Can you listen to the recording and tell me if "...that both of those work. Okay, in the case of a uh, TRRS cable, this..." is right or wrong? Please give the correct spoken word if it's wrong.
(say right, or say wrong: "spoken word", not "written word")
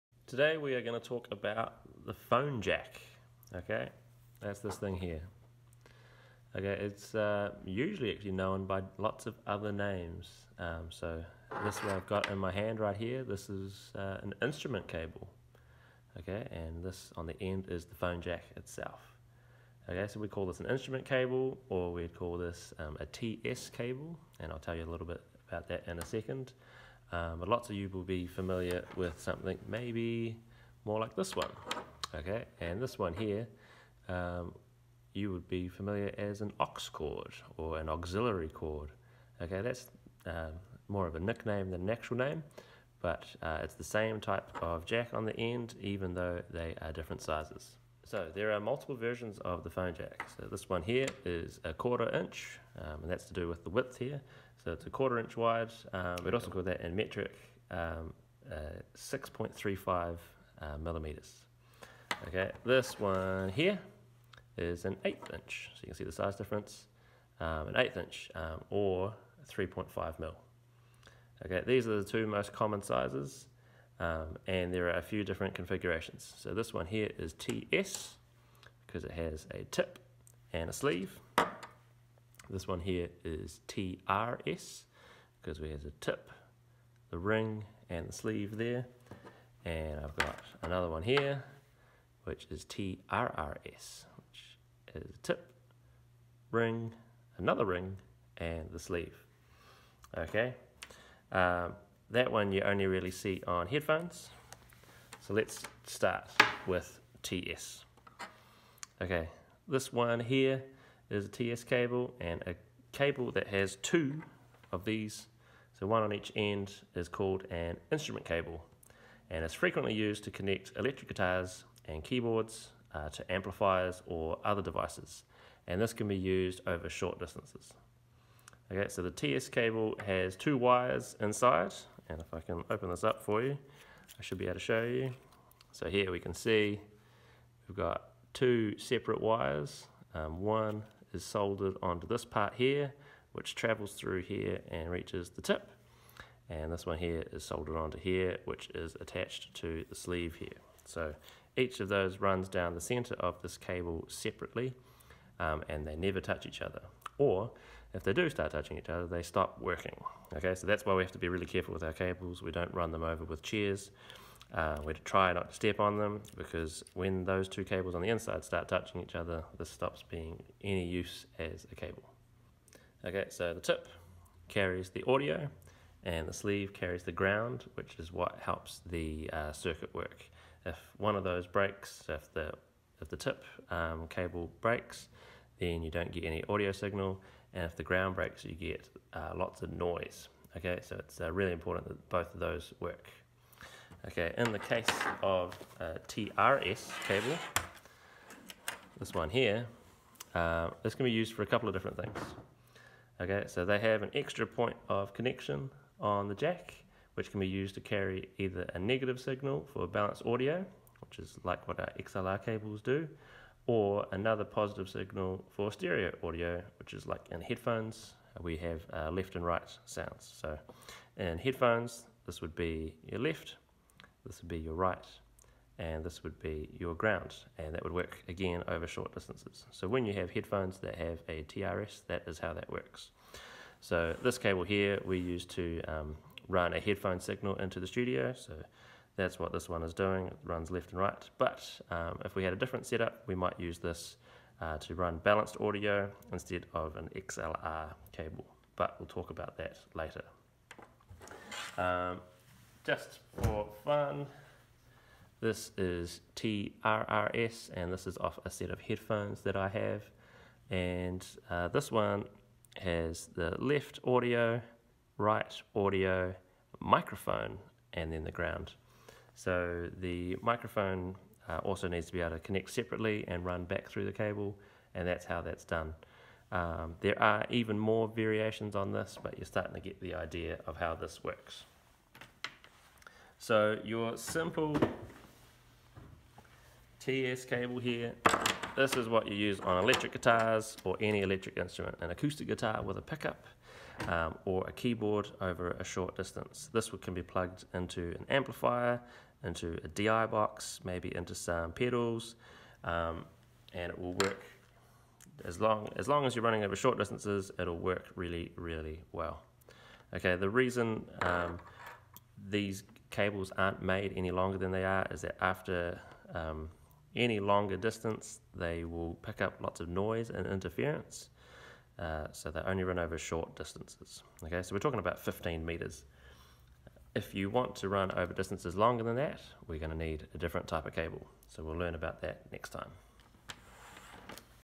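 wrong: "TRS", not "TRRS".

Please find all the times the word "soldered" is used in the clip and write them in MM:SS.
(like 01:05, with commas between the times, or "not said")
02:21, 02:27.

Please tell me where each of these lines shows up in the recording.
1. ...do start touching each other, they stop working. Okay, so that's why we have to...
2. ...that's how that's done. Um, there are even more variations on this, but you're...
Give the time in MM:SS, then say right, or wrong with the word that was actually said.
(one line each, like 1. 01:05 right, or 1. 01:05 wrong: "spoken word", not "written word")
1. 02:38 right
2. 04:35 right.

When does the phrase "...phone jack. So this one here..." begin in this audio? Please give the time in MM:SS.
00:49.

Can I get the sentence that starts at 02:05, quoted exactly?
And this can be used over short distances.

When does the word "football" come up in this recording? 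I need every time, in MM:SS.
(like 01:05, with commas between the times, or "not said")
not said.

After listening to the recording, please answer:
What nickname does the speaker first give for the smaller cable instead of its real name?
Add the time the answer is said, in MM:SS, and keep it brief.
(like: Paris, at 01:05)
aux cord, at 00:36.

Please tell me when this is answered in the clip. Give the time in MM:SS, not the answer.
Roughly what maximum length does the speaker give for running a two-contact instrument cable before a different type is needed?
05:25.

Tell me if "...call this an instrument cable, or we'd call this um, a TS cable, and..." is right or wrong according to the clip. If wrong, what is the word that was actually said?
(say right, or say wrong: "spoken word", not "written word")
right.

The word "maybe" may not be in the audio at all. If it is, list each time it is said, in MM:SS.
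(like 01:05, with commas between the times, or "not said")
00:29, 05:00.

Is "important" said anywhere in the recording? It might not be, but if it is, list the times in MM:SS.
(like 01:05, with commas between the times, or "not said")
03:11.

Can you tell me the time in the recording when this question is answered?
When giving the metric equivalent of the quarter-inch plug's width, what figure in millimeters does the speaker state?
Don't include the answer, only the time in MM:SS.
00:58.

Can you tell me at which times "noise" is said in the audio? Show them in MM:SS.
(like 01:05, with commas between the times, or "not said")
03:09, 05:19.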